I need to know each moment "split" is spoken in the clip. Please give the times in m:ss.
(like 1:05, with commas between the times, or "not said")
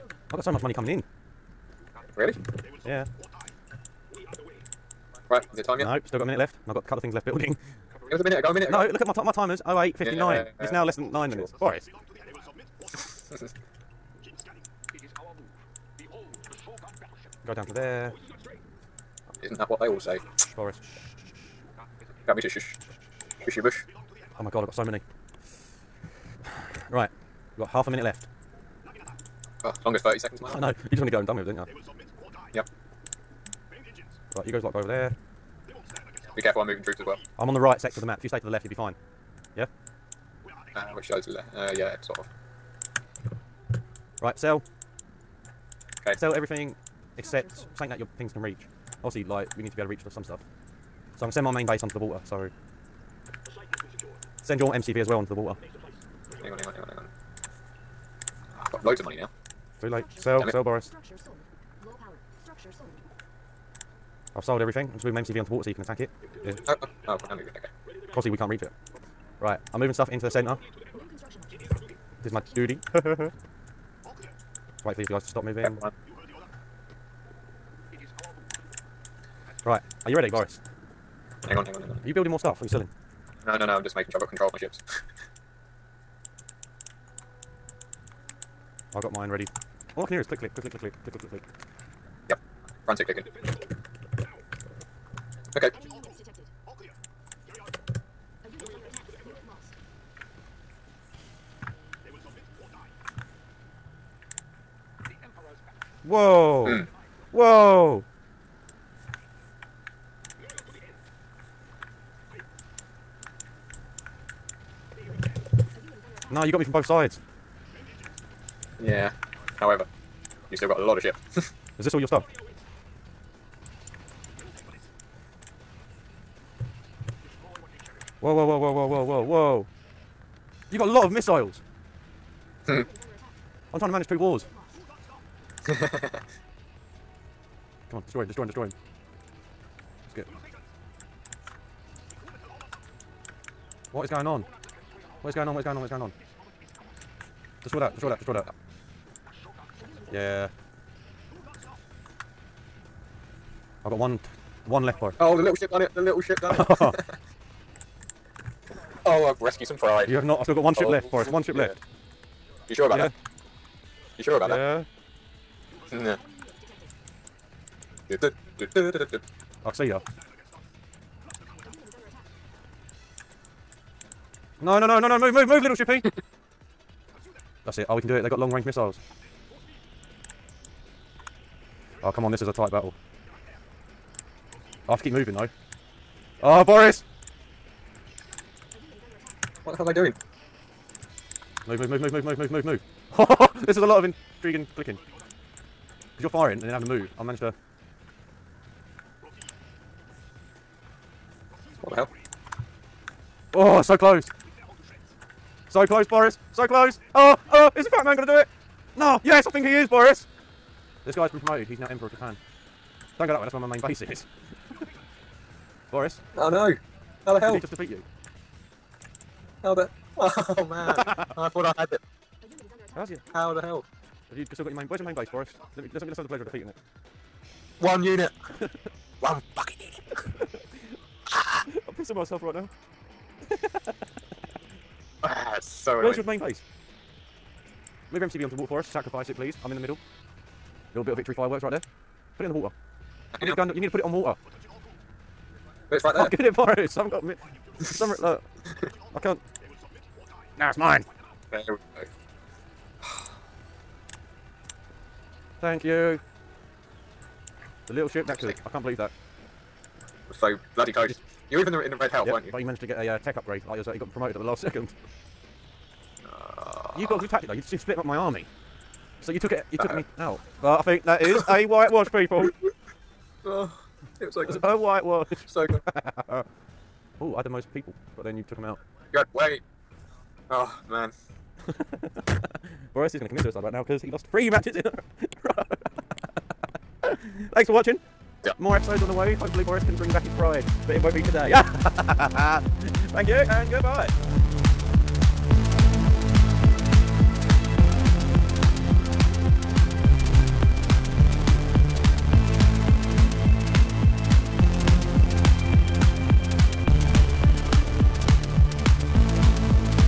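4:27.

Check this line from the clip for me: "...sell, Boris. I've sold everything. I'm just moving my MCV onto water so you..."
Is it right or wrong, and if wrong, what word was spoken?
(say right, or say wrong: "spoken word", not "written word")
right.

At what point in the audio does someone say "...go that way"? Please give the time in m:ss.
3:33.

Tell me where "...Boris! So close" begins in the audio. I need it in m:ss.
3:26.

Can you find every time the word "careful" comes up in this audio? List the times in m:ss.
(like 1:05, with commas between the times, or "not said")
0:36.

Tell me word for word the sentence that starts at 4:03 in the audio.
You need, gun, you need to put it on water.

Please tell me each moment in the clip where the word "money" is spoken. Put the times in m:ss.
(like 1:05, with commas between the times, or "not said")
0:00, 0:59.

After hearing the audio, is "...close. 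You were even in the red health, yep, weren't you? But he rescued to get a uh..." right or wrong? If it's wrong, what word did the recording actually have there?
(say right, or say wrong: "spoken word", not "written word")
wrong: "managed", not "rescued".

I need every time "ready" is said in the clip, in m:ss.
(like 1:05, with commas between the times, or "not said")
1:20, 1:29.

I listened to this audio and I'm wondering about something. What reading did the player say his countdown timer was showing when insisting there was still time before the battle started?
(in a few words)
08.59.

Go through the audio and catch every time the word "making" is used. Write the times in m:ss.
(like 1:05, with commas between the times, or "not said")
1:23.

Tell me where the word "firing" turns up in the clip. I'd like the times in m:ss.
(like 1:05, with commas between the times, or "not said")
3:16.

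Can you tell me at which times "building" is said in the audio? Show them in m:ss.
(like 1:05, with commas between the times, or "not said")
0:07, 1:22.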